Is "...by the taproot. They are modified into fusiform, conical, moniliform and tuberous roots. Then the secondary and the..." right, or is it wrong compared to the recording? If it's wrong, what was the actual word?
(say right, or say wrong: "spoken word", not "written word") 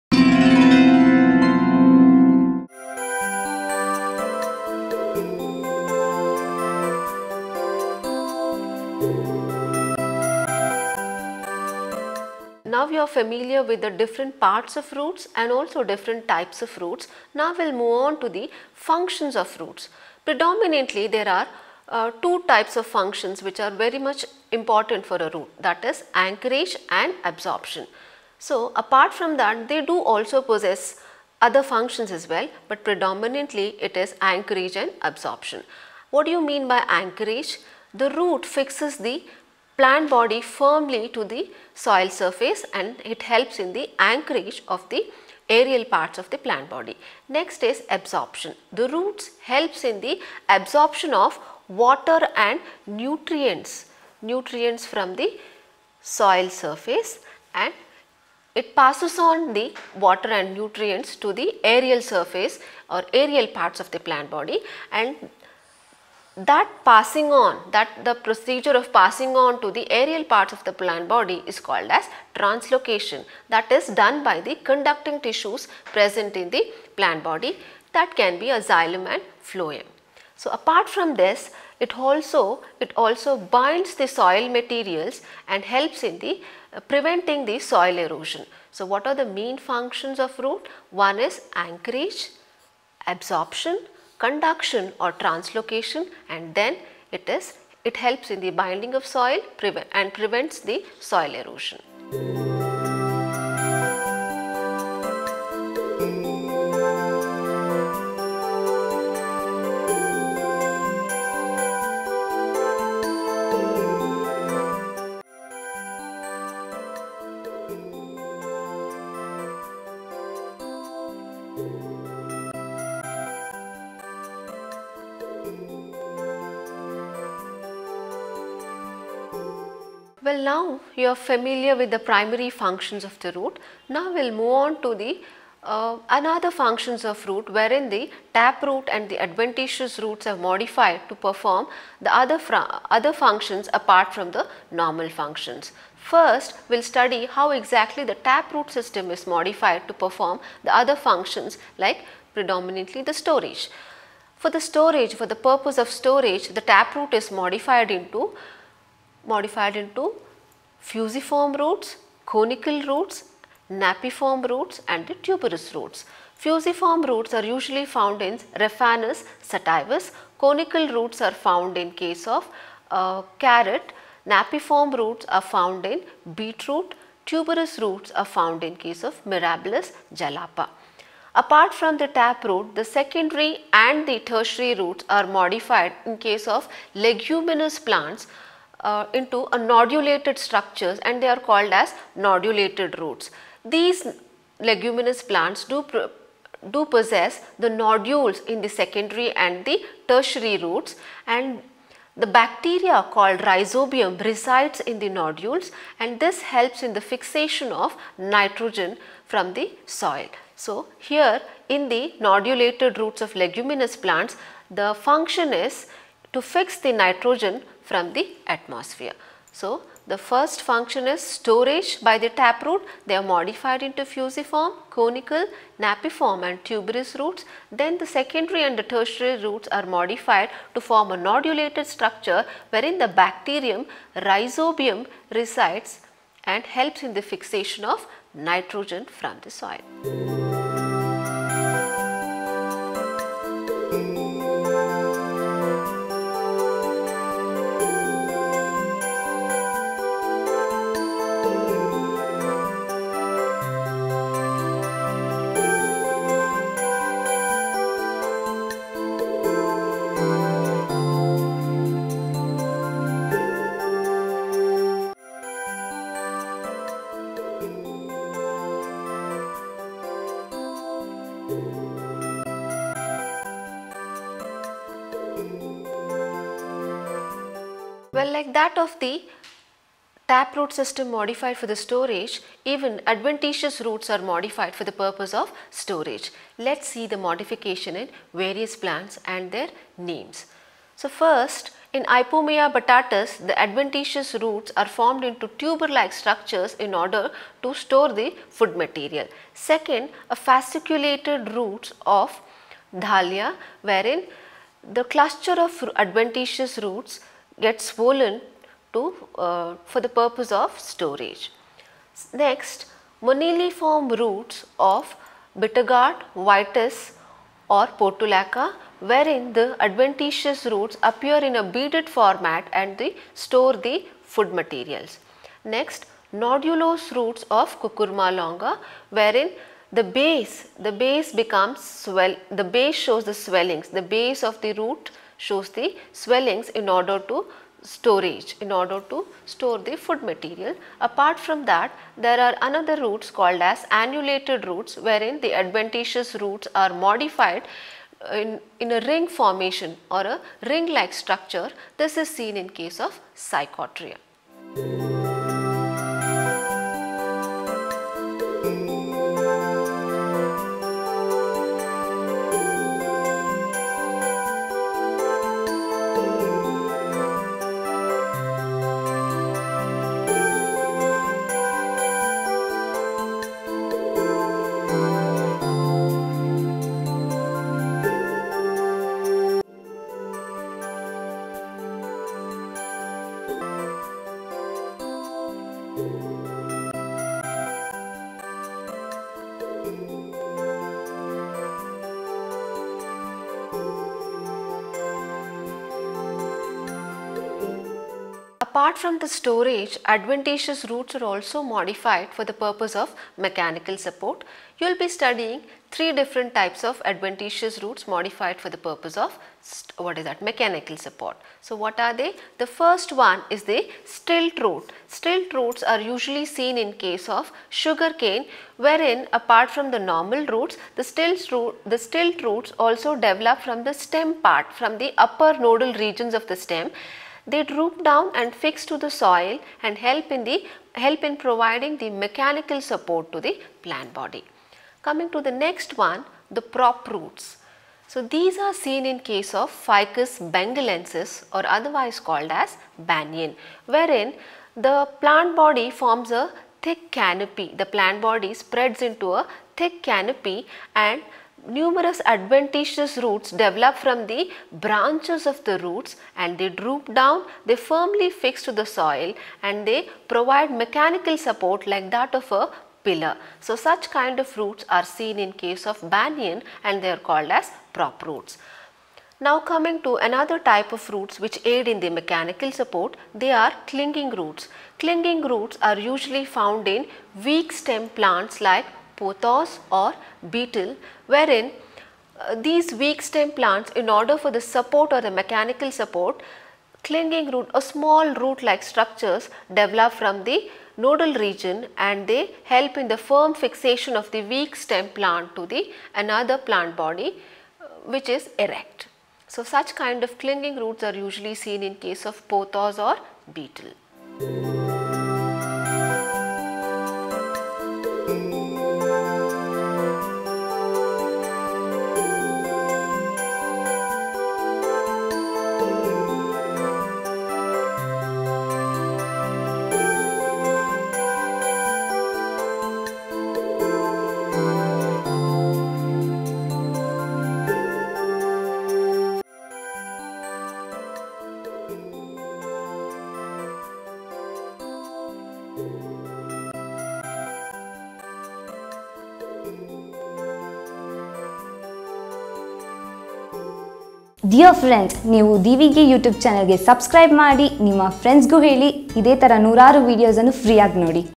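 wrong: "napiform", not "moniliform".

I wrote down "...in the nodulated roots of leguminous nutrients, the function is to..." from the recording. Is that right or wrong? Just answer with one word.
wrong.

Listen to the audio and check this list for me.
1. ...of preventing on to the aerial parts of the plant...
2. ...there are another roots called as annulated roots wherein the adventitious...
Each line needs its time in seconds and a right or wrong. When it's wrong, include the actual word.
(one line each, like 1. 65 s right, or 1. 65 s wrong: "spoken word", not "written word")
1. 68 s wrong: "passing", not "preventing"
2. 342 s right.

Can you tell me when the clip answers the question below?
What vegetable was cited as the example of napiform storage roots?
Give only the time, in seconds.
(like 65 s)
176 s.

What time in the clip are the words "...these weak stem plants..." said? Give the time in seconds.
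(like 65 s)
482 s.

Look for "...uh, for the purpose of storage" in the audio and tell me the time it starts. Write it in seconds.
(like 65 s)
309 s.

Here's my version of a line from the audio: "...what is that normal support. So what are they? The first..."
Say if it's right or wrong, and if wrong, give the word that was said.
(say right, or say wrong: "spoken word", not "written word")
wrong: "mechanical", not "normal".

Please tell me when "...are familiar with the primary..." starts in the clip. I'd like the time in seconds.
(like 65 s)
131 s.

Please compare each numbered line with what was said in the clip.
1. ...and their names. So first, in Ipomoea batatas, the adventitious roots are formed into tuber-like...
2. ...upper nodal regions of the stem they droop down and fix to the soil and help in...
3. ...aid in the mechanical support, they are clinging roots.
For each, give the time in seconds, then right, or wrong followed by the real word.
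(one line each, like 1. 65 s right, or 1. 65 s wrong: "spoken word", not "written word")
1. 289 s right
2. 425 s right
3. 471 s right.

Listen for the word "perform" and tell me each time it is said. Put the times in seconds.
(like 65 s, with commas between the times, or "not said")
141 s, 149 s.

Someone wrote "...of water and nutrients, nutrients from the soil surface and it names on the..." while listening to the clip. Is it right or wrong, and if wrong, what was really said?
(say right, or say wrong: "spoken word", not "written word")
wrong: "passes", not "names".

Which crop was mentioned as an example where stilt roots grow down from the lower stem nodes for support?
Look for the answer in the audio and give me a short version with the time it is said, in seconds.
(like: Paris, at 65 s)
Sugar cane, at 417 s.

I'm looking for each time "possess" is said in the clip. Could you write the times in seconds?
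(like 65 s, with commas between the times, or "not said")
30 s, 196 s.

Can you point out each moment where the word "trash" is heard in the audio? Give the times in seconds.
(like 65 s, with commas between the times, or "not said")
not said.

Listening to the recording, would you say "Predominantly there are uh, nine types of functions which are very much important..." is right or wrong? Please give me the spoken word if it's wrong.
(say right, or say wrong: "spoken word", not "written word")
wrong: "two", not "nine".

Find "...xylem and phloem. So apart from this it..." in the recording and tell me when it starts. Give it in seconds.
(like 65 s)
78 s.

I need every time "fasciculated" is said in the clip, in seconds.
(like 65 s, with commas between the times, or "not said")
300 s.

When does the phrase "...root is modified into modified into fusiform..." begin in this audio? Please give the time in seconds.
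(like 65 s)
156 s.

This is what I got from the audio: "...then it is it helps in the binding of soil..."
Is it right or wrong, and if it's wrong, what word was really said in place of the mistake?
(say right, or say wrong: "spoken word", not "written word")
right.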